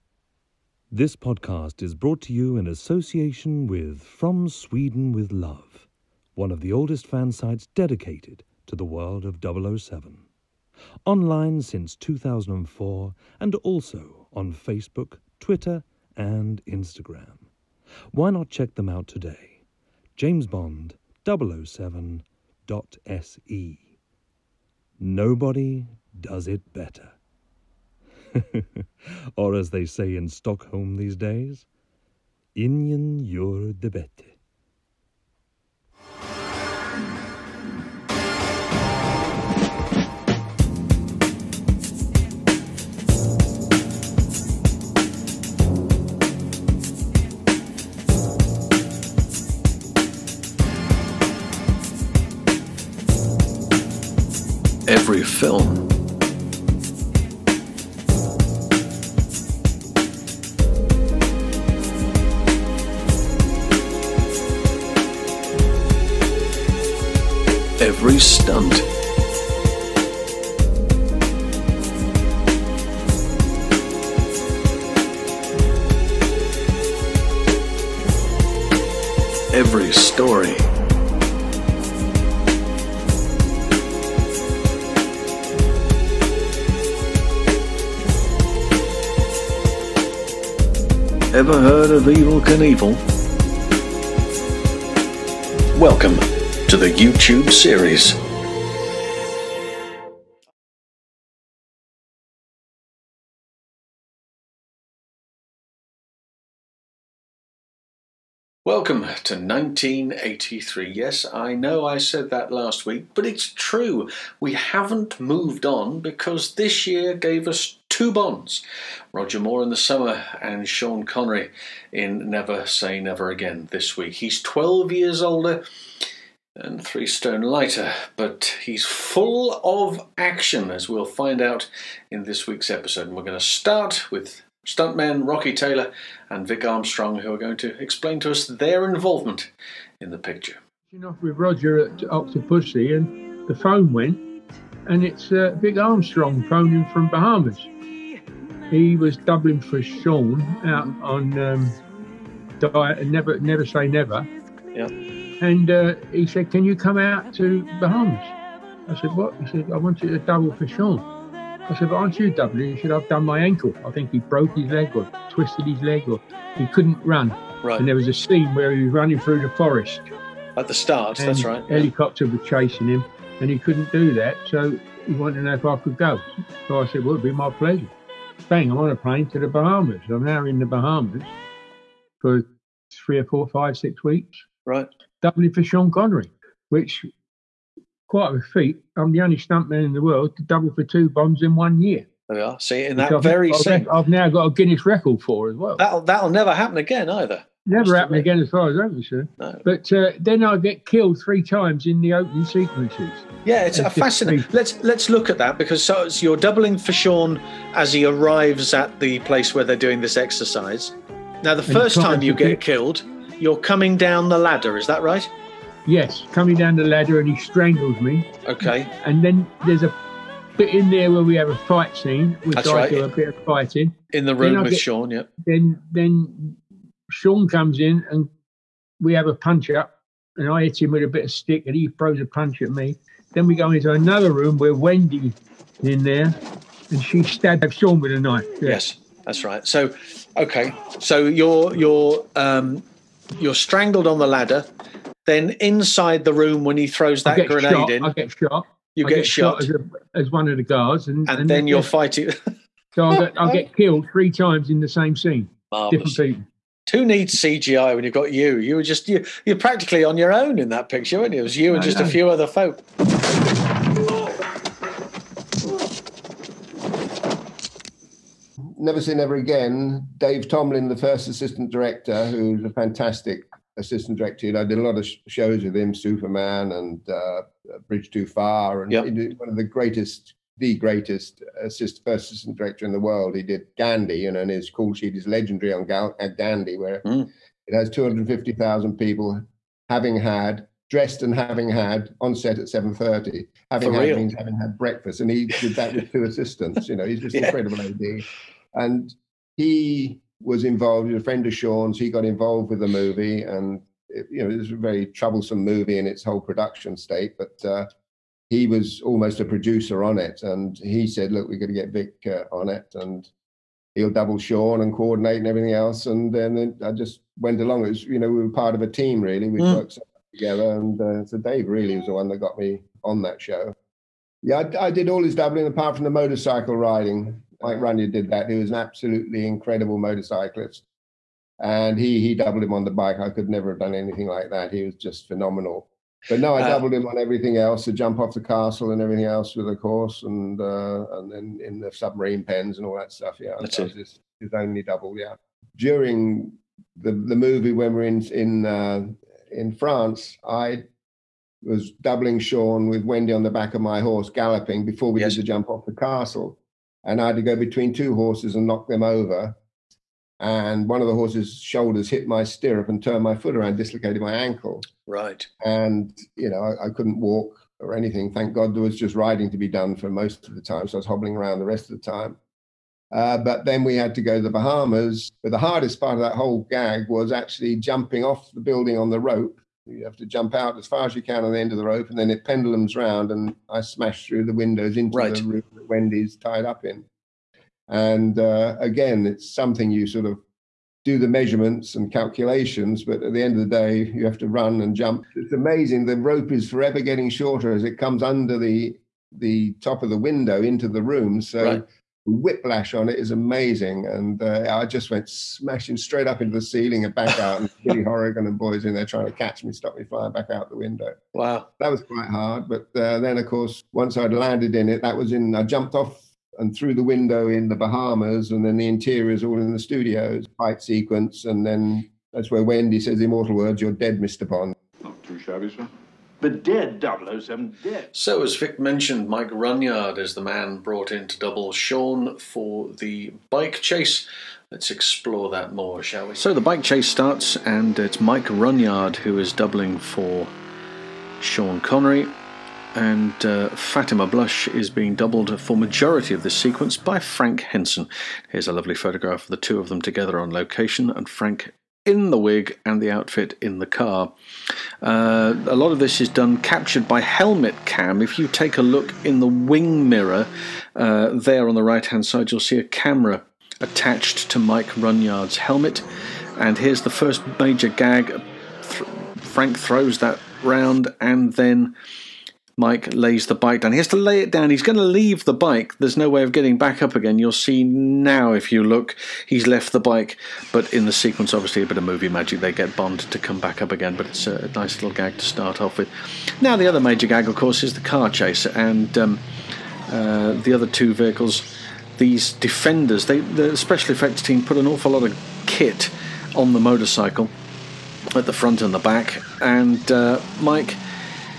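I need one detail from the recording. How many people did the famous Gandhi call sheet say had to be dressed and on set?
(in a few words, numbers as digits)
250,000.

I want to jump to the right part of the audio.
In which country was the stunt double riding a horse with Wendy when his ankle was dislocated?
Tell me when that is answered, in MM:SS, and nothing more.
05:49.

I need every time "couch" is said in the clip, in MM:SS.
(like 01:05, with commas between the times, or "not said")
not said.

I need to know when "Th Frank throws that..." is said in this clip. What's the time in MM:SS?
07:48.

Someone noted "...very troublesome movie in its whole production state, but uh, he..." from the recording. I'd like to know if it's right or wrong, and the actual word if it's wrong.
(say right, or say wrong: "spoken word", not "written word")
right.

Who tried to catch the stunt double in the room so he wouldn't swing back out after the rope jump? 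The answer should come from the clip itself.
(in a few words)
Billy Horrigan.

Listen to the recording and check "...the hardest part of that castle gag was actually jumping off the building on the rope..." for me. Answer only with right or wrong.
wrong.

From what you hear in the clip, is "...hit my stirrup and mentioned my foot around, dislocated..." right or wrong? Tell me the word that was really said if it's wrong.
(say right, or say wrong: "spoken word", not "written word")
wrong: "turned", not "mentioned".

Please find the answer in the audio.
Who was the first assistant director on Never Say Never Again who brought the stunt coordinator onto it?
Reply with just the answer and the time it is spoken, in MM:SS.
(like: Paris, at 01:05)
Dave Tomblin, at 04:30.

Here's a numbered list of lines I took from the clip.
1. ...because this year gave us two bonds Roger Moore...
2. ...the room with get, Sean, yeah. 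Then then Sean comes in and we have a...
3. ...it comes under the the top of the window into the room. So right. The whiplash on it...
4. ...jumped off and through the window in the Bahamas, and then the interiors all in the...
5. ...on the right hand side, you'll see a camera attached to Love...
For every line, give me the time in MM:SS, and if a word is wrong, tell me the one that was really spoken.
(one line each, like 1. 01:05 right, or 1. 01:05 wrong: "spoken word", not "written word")
1. 01:55 right
2. 03:44 right
3. 06:37 right
4. 06:55 right
5. 07:41 wrong: "Mike", not "Love".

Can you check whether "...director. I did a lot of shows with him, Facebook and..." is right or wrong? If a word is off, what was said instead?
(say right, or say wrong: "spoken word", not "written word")
wrong: "Superman", not "Facebook".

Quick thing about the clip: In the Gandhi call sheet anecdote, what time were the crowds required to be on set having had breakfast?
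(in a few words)
7.30.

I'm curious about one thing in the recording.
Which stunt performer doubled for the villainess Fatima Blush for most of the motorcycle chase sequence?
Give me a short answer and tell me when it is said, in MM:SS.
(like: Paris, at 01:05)
Frank Henson, at 07:27.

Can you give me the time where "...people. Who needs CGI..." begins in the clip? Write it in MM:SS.
04:16.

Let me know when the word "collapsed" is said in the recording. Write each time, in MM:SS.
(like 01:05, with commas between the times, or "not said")
not said.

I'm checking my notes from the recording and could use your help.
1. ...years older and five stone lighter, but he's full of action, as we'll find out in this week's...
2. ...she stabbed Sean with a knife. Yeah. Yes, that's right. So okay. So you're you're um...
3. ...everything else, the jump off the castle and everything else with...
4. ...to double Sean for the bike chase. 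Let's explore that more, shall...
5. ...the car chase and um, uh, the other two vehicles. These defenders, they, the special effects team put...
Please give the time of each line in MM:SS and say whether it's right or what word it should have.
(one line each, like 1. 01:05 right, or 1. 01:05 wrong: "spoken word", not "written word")
1. 02:04 wrong: "three", not "five"
2. 03:57 right
3. 05:37 right
4. 07:11 right
5. 08:07 right.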